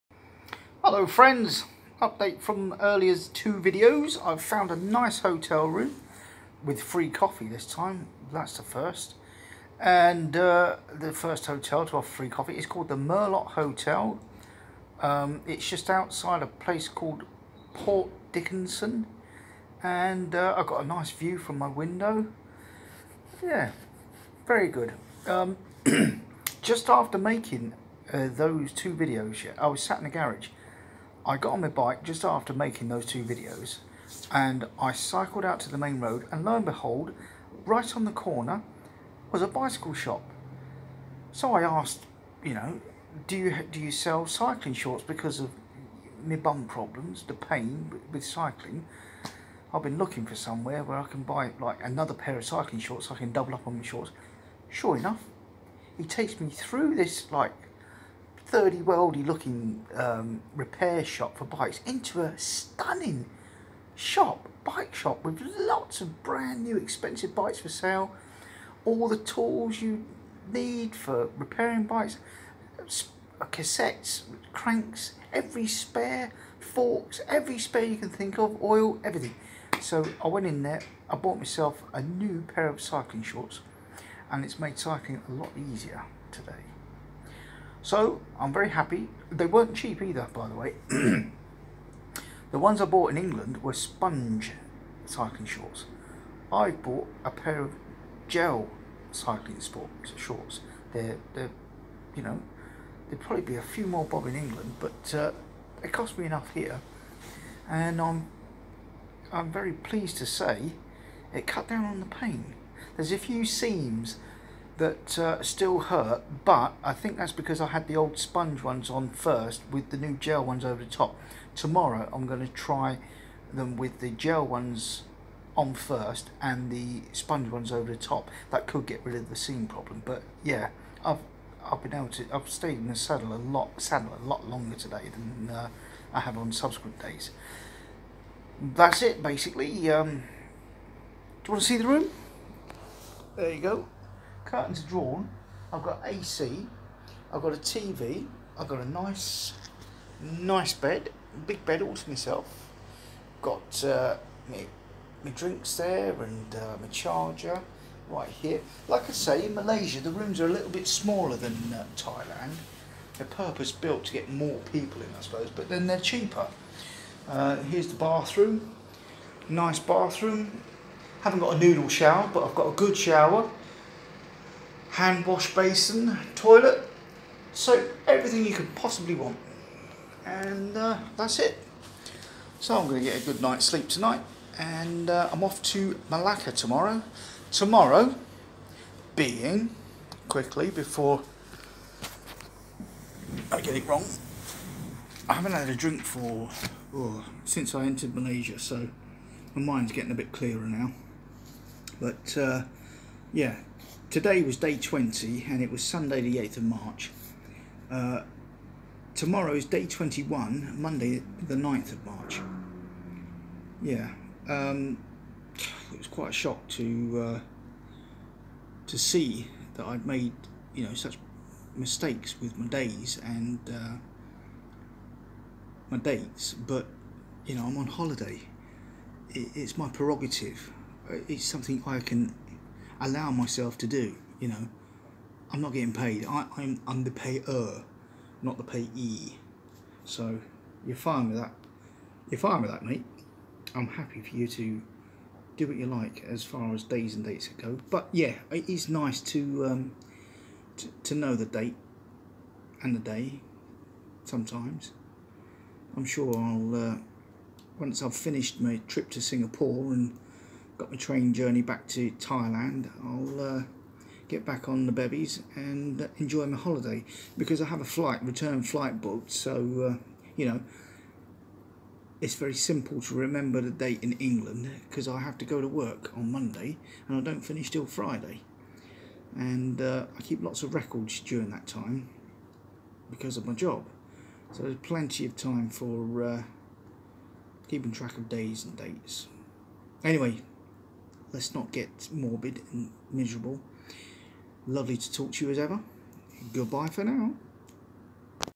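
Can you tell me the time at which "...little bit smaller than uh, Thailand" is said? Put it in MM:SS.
02:40.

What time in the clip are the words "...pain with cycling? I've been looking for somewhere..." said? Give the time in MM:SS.
00:47.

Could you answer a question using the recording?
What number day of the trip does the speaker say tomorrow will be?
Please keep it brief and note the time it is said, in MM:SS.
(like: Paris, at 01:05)
21, at 03:29.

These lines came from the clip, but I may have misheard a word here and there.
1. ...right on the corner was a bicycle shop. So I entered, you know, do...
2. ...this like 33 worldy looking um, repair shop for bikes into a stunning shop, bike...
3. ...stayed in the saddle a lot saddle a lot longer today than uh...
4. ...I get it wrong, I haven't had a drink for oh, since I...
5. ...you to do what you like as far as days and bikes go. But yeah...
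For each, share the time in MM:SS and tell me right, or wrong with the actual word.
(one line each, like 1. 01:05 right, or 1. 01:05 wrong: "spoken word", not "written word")
1. 00:37 wrong: "asked", not "entered"
2. 00:56 wrong: "30", not "33"
3. 02:12 right
4. 03:13 right
5. 04:04 wrong: "dates", not "bikes".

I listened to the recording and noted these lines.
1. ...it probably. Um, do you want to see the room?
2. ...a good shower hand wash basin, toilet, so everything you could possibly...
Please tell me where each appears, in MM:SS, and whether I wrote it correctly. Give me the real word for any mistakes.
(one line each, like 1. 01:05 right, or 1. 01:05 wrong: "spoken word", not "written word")
1. 02:19 wrong: "basically", not "probably"
2. 02:52 right.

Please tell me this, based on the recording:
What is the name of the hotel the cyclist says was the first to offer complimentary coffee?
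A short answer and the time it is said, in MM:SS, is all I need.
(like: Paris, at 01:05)
Merlot Hotel, at 00:12.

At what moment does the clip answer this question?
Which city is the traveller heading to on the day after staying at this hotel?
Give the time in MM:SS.
03:06.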